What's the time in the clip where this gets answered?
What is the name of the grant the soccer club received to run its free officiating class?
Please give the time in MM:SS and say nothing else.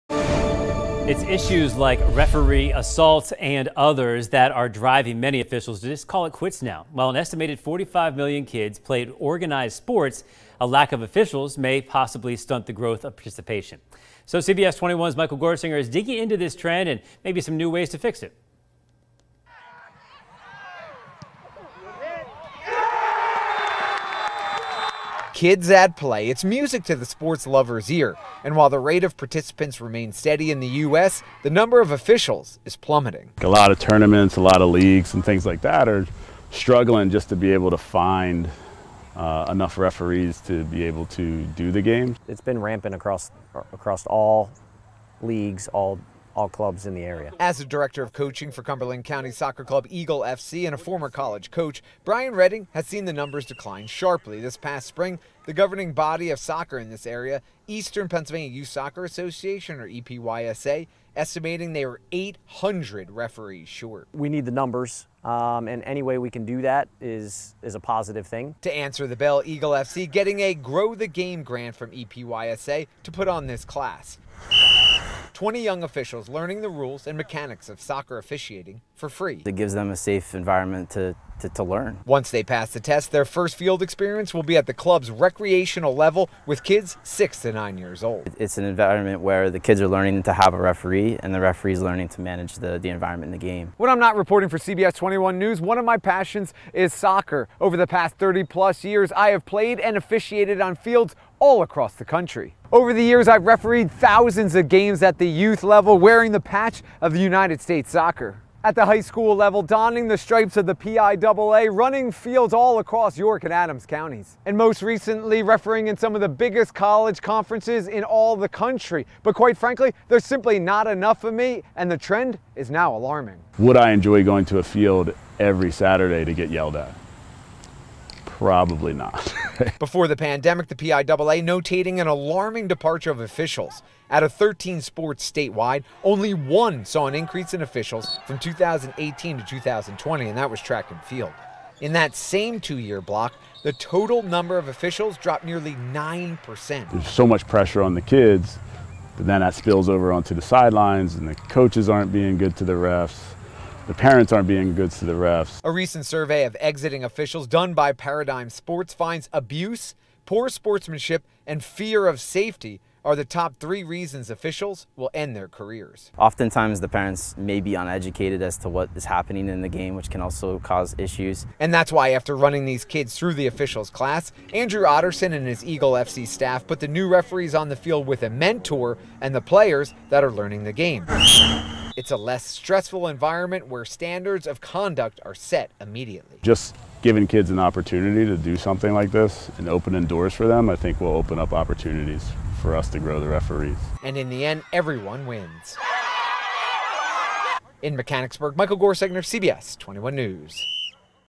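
01:10.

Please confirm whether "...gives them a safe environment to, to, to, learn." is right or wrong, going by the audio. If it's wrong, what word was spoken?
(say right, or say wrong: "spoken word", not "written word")
right.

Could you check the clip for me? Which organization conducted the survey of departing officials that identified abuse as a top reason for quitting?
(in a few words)
Paradigm Sports.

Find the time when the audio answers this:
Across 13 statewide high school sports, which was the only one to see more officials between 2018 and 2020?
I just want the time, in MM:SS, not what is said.
02:20.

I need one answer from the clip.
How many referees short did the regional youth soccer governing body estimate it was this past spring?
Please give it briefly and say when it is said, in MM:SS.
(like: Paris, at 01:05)
800, at 01:02.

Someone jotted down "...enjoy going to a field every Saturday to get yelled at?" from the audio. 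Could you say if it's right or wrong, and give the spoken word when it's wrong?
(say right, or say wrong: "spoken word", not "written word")
right.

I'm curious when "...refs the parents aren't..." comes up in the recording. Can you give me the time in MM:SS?
02:32.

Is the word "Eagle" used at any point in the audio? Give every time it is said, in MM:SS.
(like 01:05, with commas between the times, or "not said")
00:49, 01:09, 02:55.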